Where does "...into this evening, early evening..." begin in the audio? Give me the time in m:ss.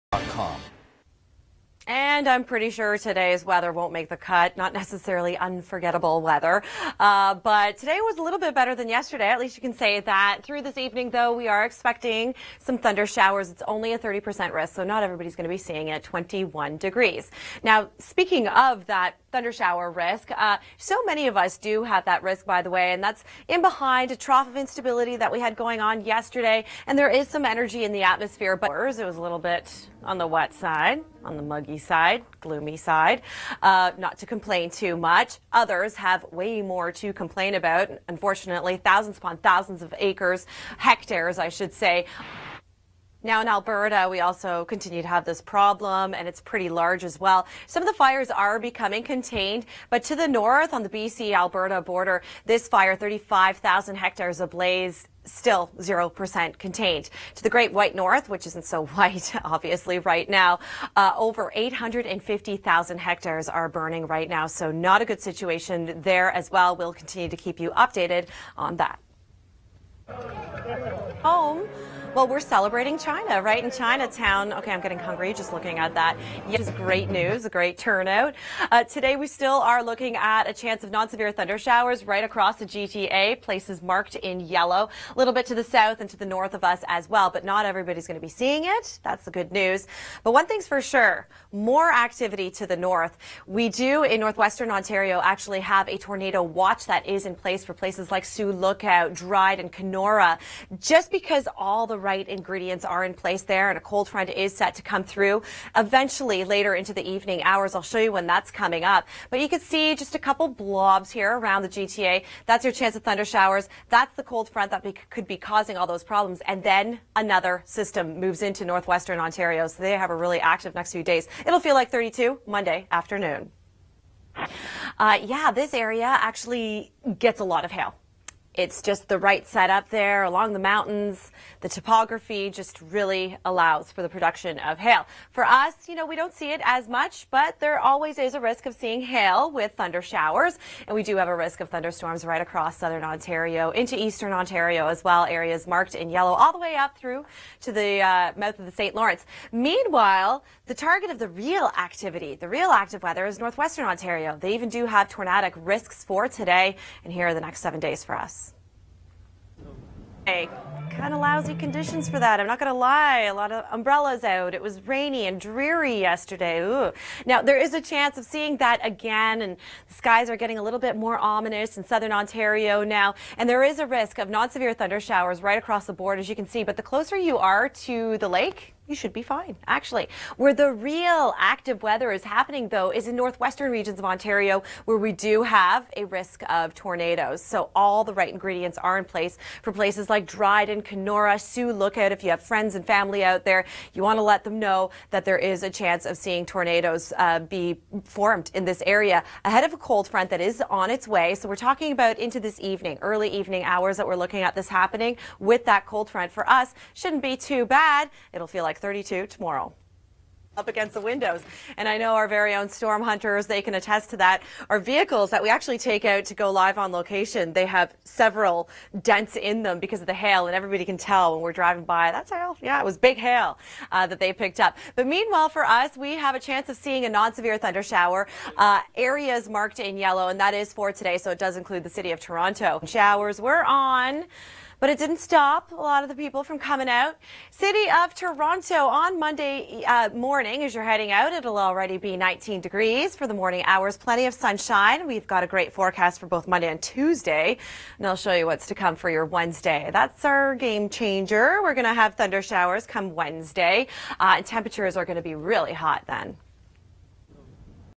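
3:22.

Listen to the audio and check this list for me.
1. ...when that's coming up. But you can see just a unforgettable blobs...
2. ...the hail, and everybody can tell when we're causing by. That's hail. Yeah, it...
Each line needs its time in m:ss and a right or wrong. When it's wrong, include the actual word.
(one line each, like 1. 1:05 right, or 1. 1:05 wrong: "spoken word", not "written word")
1. 1:48 wrong: "couple", not "unforgettable"
2. 3:40 wrong: "driving", not "causing".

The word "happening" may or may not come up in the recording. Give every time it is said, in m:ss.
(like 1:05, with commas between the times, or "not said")
3:02, 3:24.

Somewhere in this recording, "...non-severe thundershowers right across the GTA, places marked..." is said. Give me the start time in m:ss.
1:20.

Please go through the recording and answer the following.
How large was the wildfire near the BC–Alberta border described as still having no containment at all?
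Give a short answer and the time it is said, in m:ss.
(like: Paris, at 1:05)
35,000 hectares, at 0:52.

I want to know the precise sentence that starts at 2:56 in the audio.
But the closer you are to the lake, you should be fine, actually.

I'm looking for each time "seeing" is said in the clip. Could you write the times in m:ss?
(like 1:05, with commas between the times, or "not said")
0:15, 1:28, 2:18, 2:48, 3:16, 3:46.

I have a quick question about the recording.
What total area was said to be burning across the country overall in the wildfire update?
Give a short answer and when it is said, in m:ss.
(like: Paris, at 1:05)
over 850,000 hectares, at 1:01.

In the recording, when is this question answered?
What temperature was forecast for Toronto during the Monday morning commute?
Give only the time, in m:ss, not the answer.
4:02.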